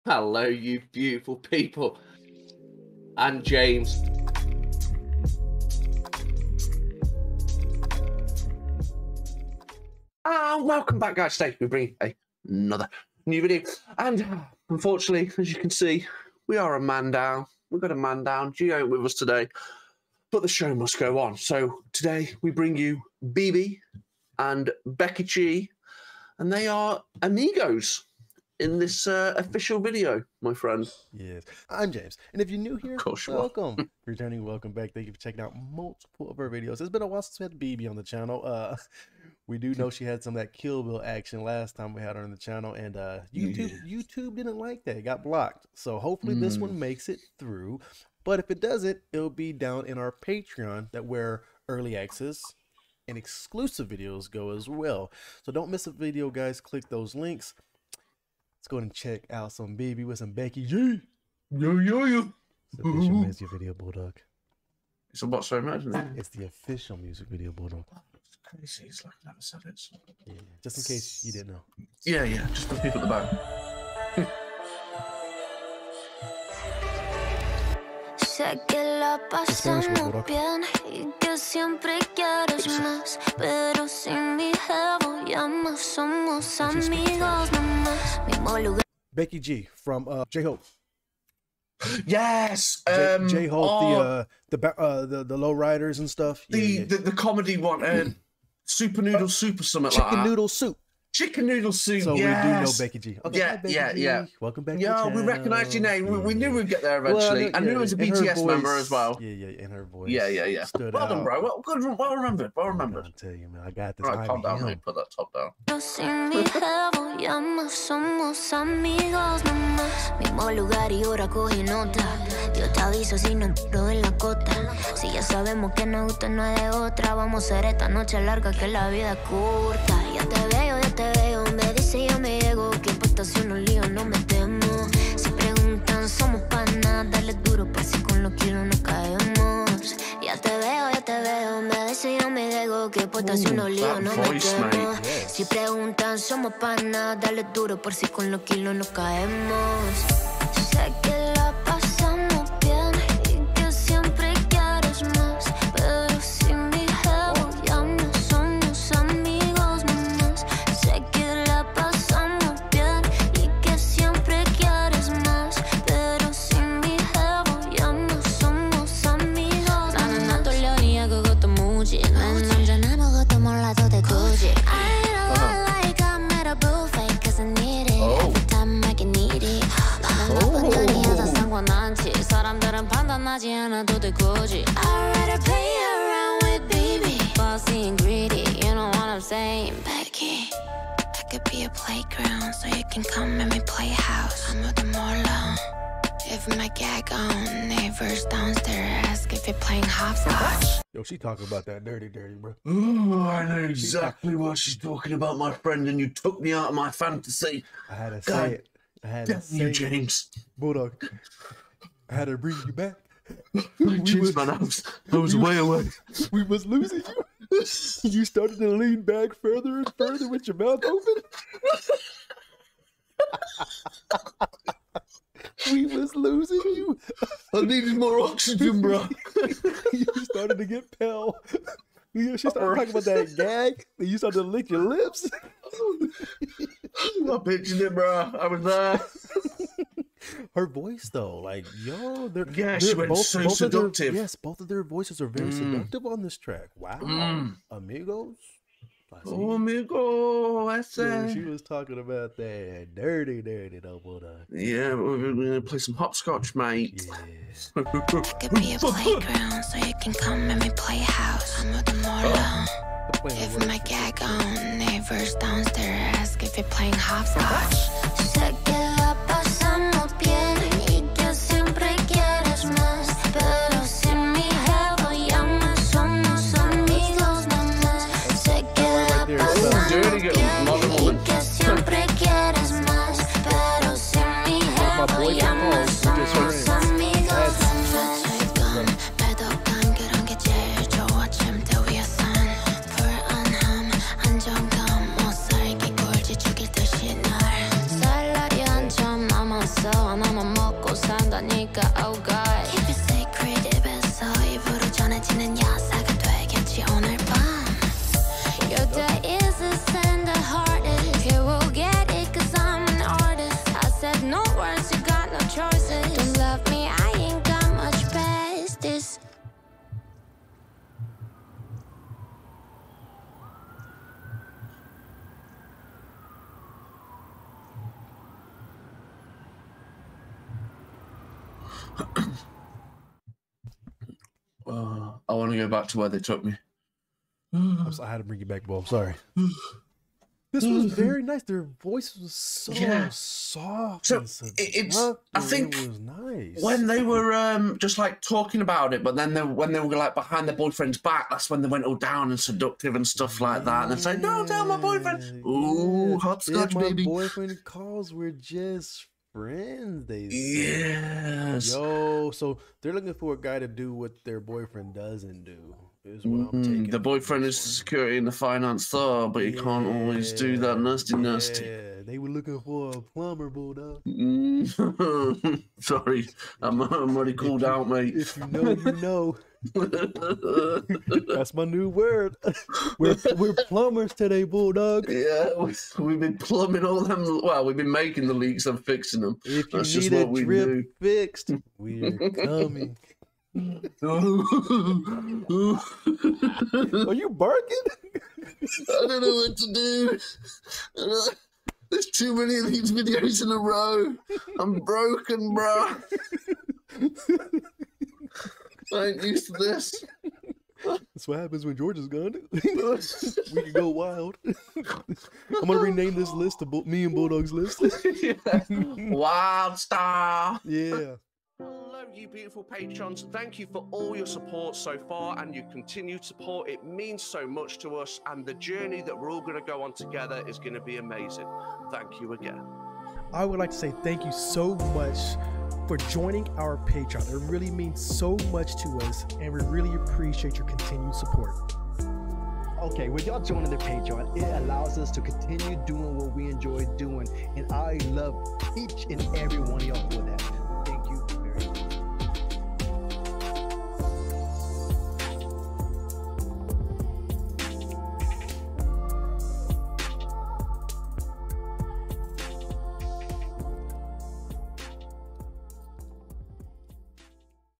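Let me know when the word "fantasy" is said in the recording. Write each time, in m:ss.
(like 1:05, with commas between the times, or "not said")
3:26.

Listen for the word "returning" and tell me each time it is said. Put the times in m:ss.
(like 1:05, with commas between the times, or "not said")
0:34.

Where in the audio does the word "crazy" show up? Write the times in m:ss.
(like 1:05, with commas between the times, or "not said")
1:08.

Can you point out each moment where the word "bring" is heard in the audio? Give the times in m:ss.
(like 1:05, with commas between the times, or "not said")
0:11, 0:22, 3:32, 5:38.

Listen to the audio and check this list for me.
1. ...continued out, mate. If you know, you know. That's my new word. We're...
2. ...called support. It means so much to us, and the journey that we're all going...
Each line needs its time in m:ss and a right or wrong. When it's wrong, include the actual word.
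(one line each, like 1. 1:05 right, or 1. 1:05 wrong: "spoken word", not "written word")
1. 6:17 wrong: "called", not "continued"
2. 7:05 wrong: "continued", not "called".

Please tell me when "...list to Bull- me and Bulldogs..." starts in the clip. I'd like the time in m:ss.
6:56.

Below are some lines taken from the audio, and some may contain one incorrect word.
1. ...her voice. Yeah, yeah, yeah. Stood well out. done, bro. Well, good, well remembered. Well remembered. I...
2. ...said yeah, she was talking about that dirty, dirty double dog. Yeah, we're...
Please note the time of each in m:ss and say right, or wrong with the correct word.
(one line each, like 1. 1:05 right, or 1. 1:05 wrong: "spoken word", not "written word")
1. 1:49 right
2. 4:10 right.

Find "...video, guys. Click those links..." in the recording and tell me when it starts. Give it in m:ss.
0:55.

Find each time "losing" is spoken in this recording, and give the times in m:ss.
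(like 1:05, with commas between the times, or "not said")
3:36, 3:46.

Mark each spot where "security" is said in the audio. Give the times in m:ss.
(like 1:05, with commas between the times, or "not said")
6:07.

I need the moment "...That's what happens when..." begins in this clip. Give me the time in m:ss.
6:50.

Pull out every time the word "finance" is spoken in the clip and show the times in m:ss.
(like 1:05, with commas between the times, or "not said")
6:08.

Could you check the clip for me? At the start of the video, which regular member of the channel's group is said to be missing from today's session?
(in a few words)
Geo.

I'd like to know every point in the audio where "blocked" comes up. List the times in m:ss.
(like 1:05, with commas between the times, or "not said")
0:45.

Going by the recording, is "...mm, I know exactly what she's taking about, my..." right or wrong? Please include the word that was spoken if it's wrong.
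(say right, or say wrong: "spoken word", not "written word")
wrong: "talking", not "taking".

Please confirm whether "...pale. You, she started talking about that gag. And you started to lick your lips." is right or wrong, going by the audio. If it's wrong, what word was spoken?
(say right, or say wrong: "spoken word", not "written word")
right.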